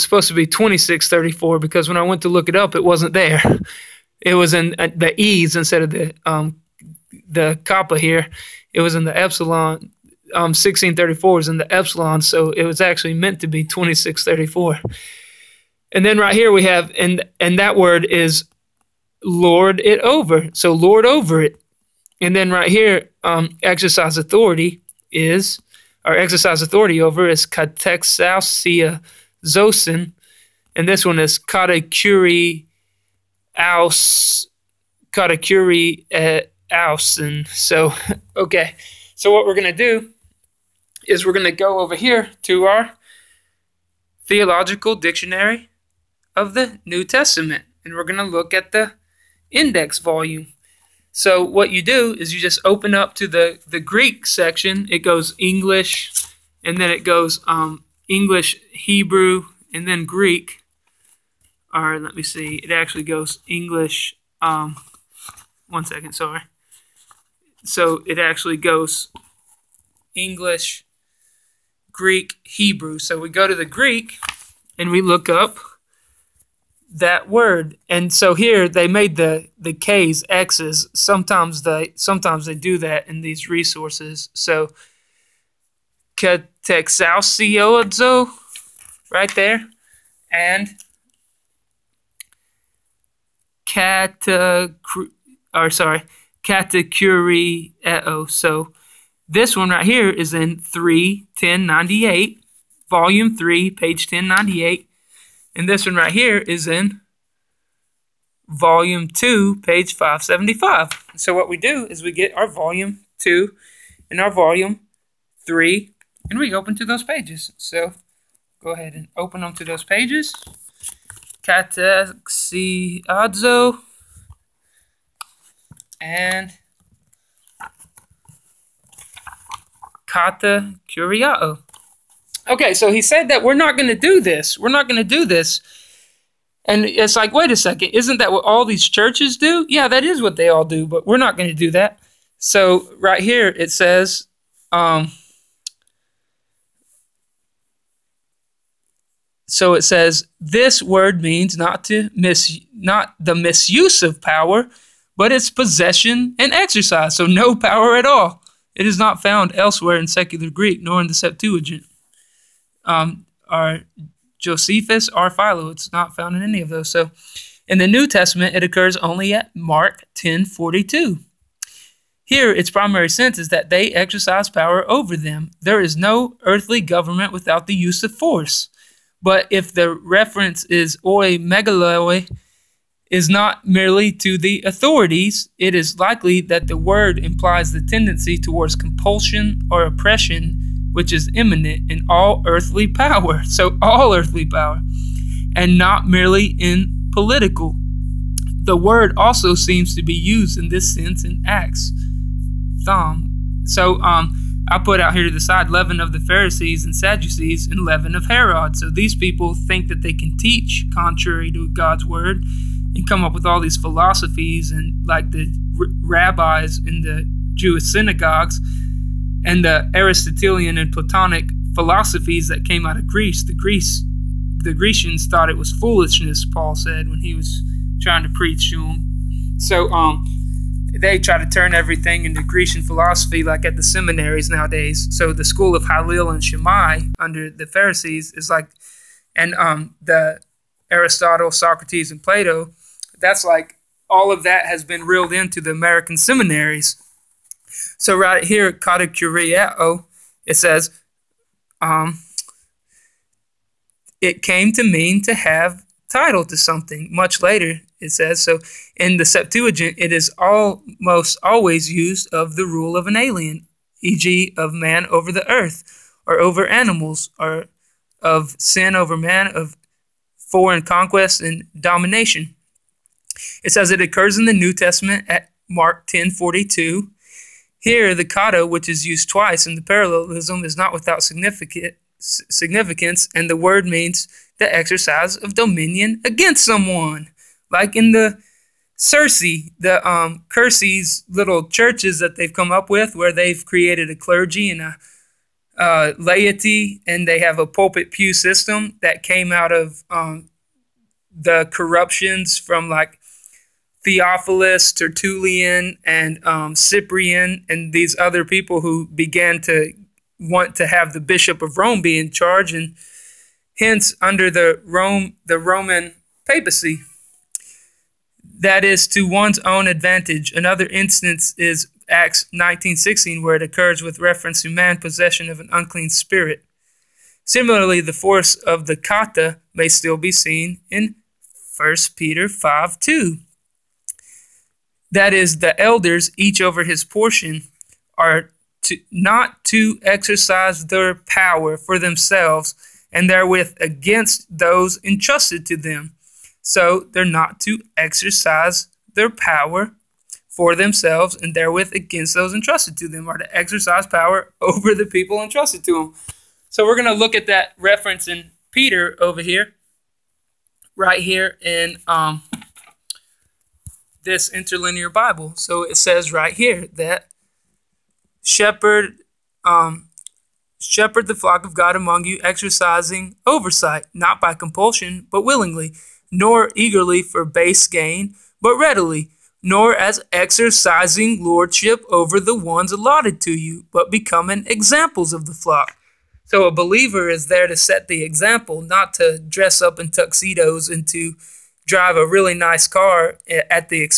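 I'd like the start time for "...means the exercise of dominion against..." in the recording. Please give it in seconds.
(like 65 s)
283 s.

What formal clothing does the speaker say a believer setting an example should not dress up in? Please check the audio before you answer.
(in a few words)
tuxedos.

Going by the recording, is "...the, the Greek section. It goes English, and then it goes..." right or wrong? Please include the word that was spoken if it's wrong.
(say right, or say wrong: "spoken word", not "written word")
right.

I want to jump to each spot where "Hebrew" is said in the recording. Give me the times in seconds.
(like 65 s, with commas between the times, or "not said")
58 s, 72 s.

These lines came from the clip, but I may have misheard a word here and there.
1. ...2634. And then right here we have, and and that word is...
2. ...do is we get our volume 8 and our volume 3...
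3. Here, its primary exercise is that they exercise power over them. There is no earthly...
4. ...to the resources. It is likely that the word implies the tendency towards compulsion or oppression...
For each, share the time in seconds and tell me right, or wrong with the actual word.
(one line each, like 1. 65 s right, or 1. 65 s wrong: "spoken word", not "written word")
1. 13 s right
2. 111 s wrong: "2", not "8"
3. 172 s wrong: "sense", not "exercise"
4. 184 s wrong: "authorities", not "resources".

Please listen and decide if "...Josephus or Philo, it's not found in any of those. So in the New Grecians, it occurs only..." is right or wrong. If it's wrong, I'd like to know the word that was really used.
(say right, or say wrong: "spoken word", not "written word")
wrong: "Testament", not "Grecians".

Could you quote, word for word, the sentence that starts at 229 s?
So um, they try to turn everything into Grecian philosophy, like at the seminaries nowadays.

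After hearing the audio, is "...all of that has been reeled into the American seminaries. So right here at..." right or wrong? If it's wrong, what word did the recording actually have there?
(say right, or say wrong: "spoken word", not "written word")
right.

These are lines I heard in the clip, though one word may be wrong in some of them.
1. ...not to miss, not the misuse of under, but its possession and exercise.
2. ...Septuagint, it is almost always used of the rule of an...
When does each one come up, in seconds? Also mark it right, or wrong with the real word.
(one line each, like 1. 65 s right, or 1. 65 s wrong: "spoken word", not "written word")
1. 151 s wrong: "power", not "under"
2. 259 s right.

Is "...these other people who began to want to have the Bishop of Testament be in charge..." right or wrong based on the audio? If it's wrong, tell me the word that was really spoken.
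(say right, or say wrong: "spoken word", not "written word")
wrong: "Rome", not "Testament".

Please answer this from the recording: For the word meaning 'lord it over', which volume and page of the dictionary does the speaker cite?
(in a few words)
Volume 2, page 575.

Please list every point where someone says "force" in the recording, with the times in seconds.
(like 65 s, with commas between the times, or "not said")
178 s, 328 s.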